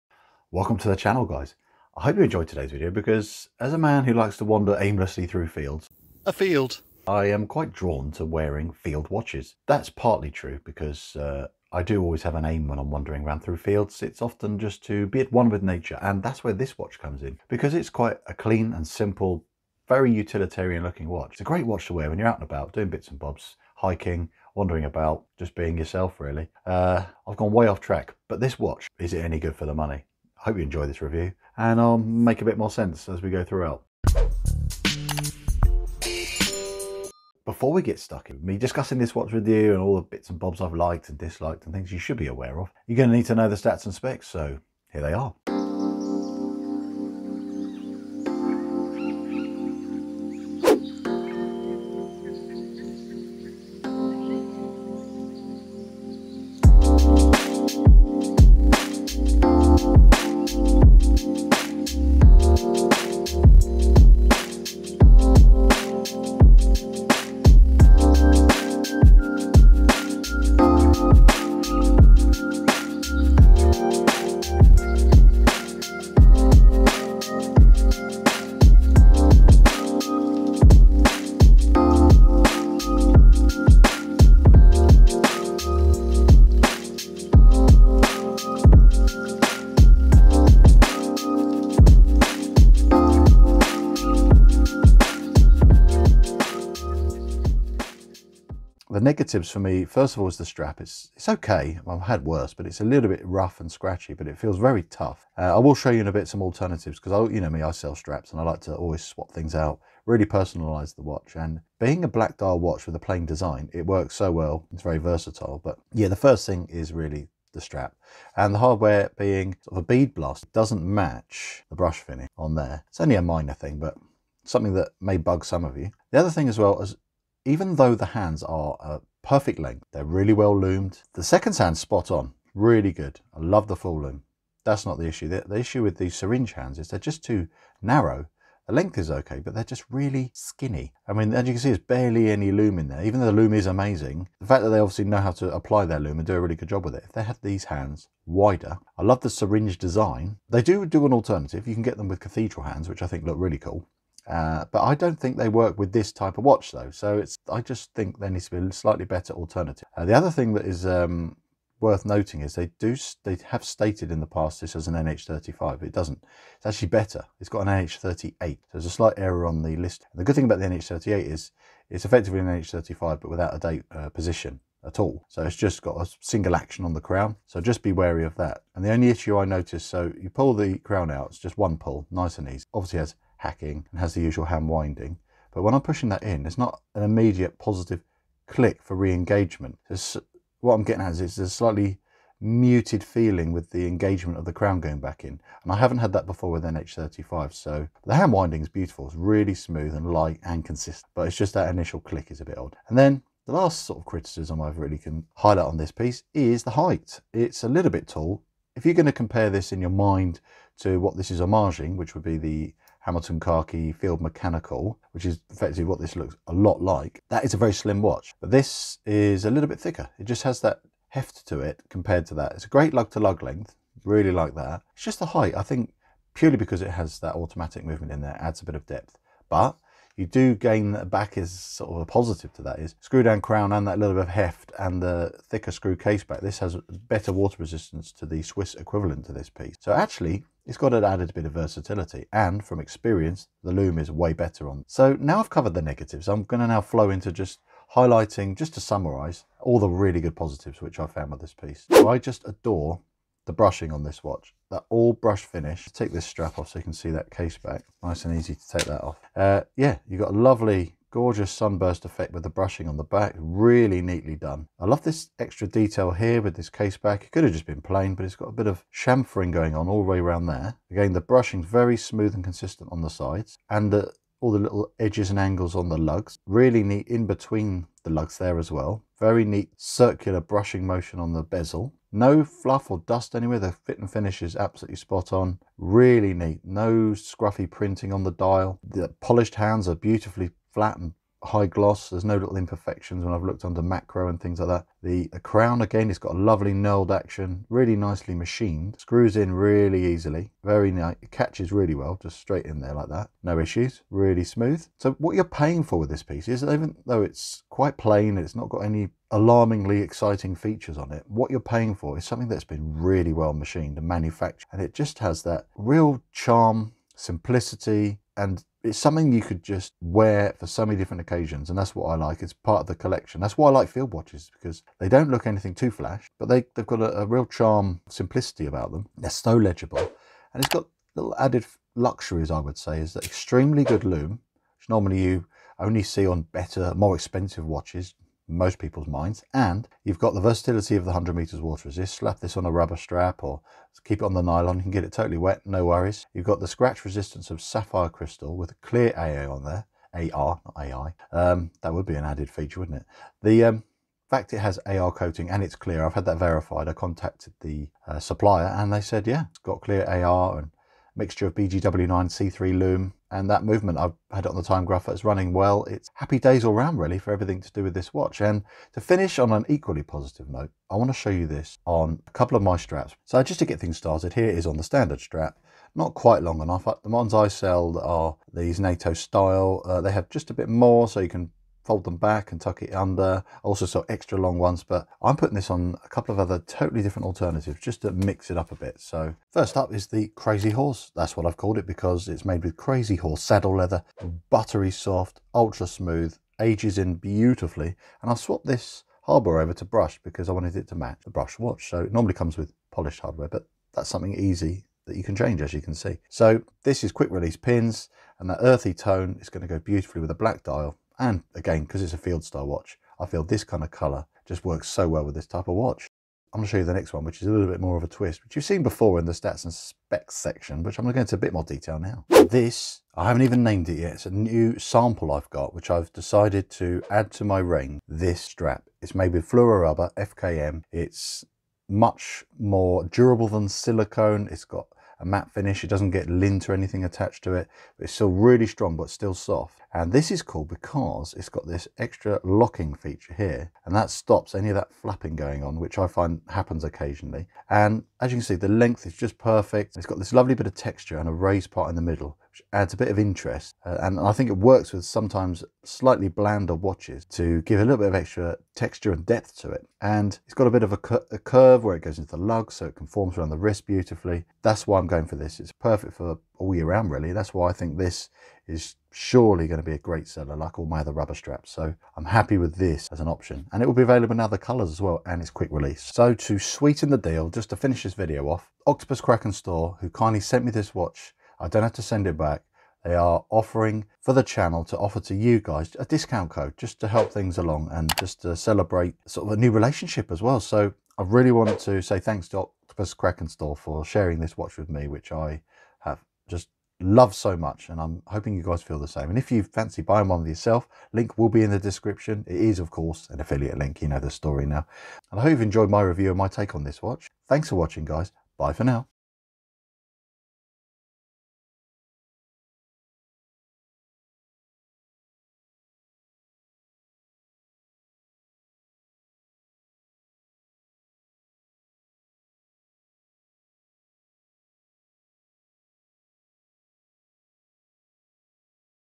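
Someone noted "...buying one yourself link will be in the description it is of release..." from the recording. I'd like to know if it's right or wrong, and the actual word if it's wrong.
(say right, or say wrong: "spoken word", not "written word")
wrong: "course", not "release".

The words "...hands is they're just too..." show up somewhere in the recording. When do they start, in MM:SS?
02:16.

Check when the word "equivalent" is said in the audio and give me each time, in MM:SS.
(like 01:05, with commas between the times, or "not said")
03:58.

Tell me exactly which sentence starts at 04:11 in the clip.
So I just adore the brushing on this watch, that all brush finish.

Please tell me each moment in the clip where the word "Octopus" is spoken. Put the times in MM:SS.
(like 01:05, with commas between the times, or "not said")
07:58, 08:12.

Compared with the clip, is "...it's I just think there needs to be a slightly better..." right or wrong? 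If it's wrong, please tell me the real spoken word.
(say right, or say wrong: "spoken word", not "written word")
right.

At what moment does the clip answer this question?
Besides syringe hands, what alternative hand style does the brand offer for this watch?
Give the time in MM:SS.
02:32.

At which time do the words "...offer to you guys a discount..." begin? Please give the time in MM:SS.
08:04.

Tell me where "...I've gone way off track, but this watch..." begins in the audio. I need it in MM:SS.
00:27.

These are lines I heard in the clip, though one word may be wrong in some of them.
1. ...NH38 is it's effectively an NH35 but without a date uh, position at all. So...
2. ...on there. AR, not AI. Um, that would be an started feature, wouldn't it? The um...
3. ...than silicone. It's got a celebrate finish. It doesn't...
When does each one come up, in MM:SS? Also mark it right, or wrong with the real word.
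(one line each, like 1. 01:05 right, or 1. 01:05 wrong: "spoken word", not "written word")
1. 02:50 right
2. 05:49 wrong: "added", not "started"
3. 07:13 wrong: "matte", not "celebrate".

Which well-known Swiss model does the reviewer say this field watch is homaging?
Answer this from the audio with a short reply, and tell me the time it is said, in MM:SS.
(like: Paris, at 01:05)
Hamilton Khaki Field Mechanical, at 03:33.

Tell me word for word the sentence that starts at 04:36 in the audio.
Really neat in between the lugs there as well.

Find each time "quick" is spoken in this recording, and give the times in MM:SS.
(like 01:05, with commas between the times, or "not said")
06:47, 07:55.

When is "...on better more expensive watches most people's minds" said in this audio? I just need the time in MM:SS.
05:36.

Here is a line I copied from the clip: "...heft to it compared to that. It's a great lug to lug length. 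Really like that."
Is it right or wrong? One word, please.
right.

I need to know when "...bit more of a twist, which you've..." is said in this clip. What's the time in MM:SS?
06:57.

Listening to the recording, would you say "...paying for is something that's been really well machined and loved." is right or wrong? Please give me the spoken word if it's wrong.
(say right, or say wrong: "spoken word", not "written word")
wrong: "manufactured", not "loved".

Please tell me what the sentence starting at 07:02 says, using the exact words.
This, I haven't even named it yet.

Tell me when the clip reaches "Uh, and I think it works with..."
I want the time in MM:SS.
07:33.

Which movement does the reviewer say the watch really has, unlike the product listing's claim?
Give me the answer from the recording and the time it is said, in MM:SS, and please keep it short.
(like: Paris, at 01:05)
NH38, at 02:47.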